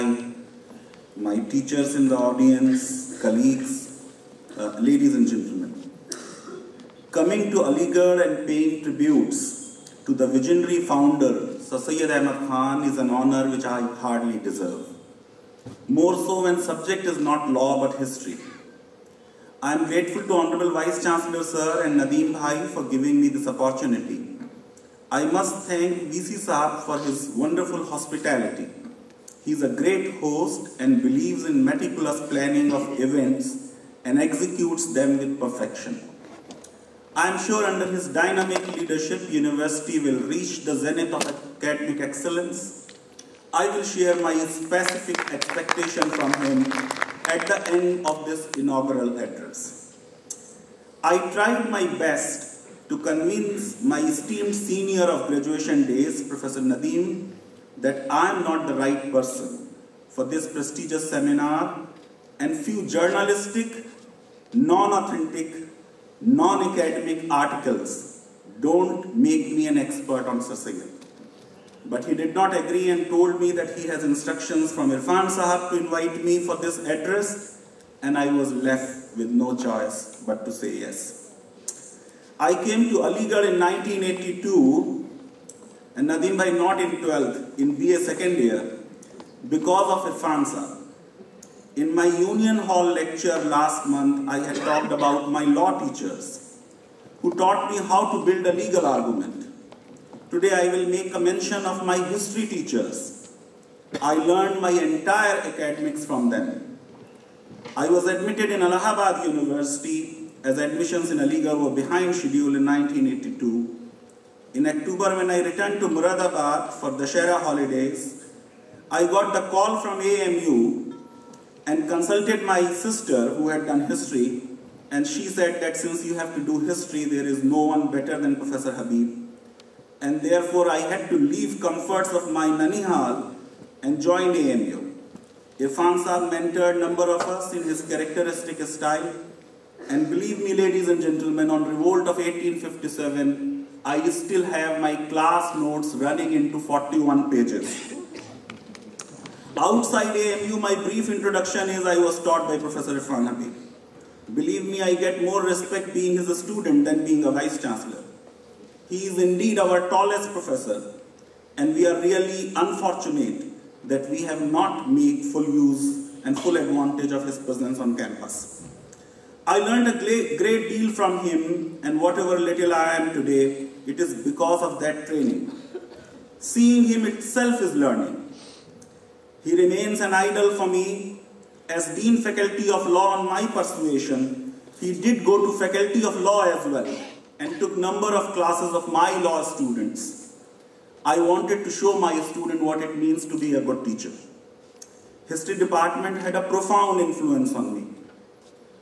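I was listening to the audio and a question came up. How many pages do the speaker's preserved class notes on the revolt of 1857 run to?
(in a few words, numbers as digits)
41.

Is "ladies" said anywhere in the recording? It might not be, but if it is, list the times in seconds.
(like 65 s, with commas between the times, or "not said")
4 s, 140 s.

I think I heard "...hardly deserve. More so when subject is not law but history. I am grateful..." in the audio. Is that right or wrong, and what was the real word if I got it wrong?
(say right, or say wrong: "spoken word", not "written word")
right.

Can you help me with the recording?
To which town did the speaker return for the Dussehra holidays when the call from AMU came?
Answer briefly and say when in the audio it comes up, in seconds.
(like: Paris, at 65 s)
Moradabad, at 115 s.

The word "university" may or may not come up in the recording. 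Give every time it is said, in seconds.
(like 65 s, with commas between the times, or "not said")
39 s, 109 s.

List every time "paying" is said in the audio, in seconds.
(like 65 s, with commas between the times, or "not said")
8 s.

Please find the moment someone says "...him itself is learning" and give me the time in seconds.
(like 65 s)
176 s.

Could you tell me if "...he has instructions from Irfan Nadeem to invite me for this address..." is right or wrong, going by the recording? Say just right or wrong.
wrong.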